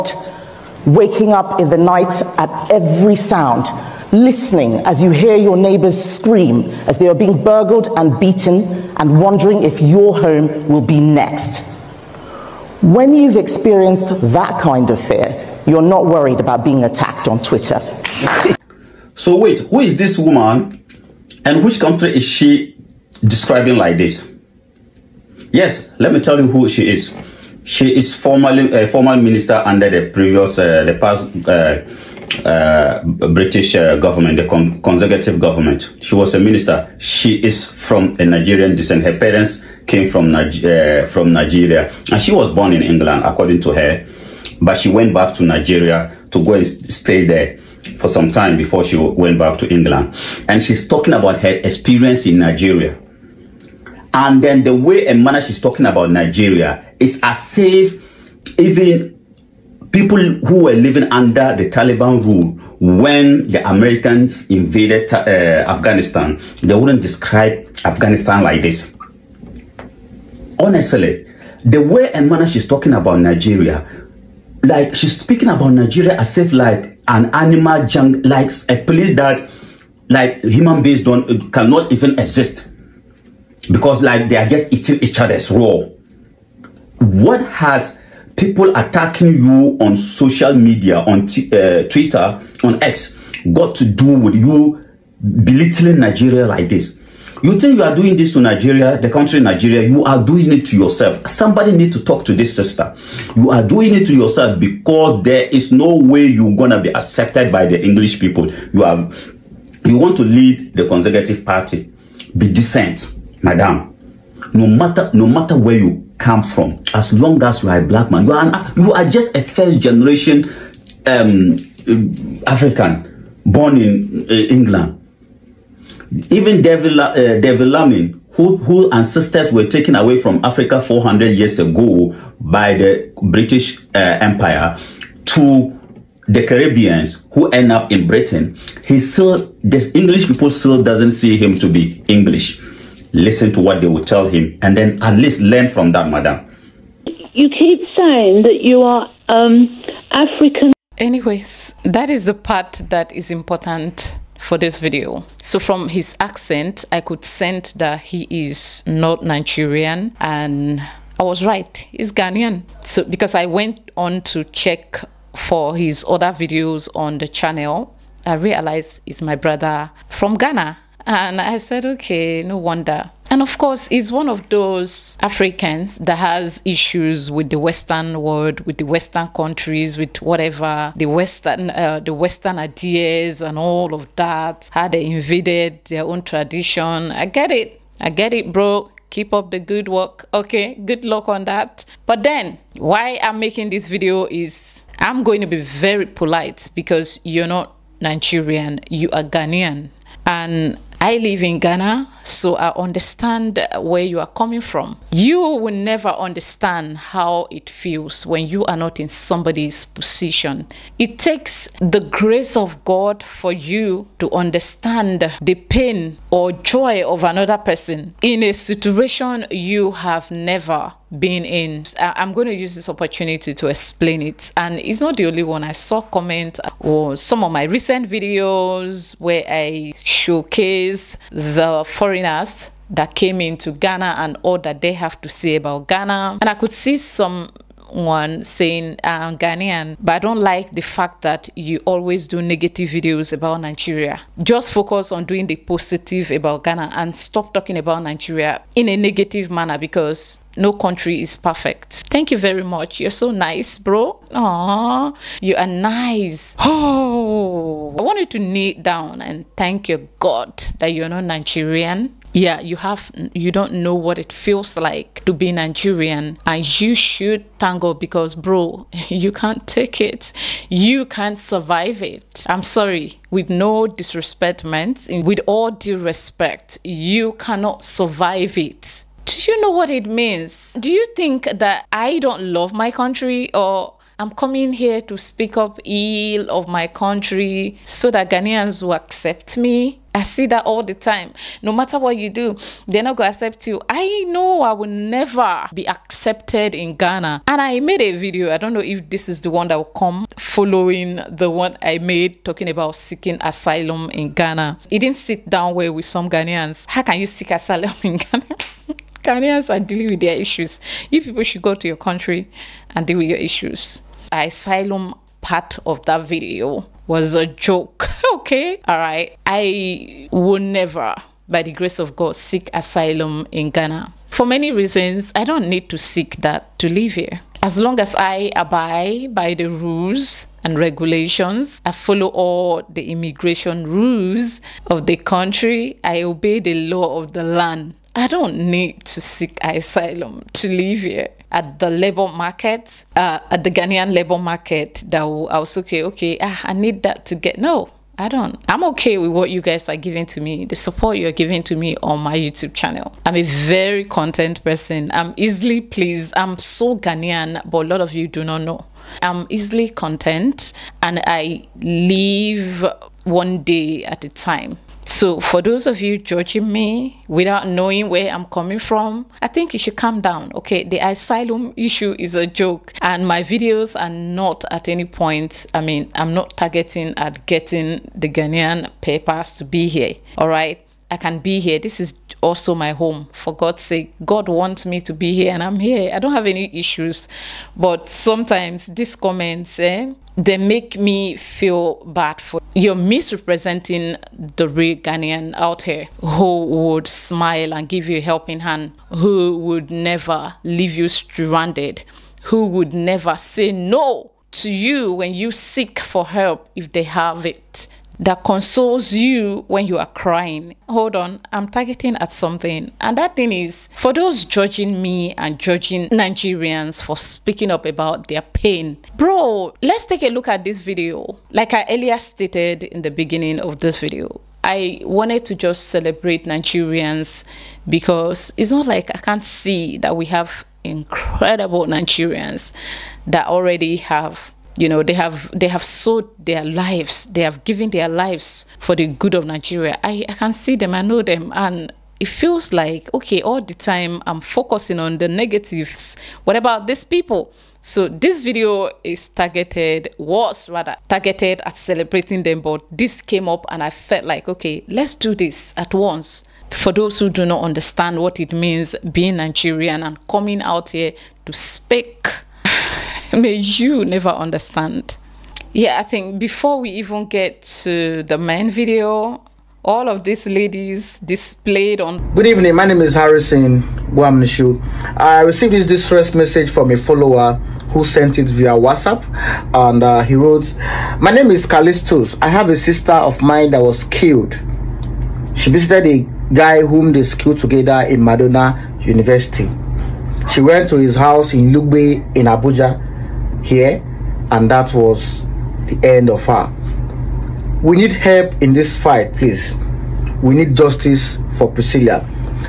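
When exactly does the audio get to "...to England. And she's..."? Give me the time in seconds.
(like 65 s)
49 s.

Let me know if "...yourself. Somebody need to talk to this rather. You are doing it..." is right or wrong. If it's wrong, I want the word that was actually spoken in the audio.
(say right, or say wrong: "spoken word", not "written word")
wrong: "sister", not "rather".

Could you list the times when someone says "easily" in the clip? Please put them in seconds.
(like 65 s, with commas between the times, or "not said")
355 s, 359 s.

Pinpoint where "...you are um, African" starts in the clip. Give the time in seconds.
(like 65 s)
148 s.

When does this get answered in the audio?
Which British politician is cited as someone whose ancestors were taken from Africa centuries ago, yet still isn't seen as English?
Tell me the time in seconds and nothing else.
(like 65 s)
127 s.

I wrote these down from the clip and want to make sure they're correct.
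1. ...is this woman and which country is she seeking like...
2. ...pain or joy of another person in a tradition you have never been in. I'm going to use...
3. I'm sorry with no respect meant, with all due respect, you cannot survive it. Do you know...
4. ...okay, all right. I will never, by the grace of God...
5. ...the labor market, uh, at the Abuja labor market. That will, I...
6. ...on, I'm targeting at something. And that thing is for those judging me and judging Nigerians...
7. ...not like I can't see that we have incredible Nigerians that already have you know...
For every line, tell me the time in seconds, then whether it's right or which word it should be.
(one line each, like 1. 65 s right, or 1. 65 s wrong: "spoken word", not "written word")
1. 19 s wrong: "describing", not "seeking"
2. 215 s wrong: "situation", not "tradition"
3. 272 s wrong: "disrespect", not "respect"
4. 318 s right
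5. 341 s wrong: "Ghanaian", not "Abuja"
6. 411 s right
7. 428 s right.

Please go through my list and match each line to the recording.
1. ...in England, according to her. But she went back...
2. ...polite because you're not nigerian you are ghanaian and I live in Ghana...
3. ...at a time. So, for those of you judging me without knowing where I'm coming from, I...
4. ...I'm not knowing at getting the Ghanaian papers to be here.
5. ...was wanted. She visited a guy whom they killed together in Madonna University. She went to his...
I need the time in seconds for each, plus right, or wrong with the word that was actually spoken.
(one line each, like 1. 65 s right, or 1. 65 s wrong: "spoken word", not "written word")
1. 42 s right
2. 196 s right
3. 364 s right
4. 376 s wrong: "targeting", not "knowing"
5. 483 s wrong: "killed", not "wanted".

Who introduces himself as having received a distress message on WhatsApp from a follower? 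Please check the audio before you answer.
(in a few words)
Harrison Gwamnishu.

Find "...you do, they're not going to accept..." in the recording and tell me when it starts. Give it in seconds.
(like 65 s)
292 s.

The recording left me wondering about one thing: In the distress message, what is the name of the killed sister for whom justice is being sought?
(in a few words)
Priscilla.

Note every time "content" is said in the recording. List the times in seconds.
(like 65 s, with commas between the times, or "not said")
354 s, 359 s.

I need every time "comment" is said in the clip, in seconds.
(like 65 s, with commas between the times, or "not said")
226 s, 389 s.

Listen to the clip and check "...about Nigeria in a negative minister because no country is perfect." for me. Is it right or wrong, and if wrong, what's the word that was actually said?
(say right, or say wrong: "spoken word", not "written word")
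wrong: "manner", not "minister".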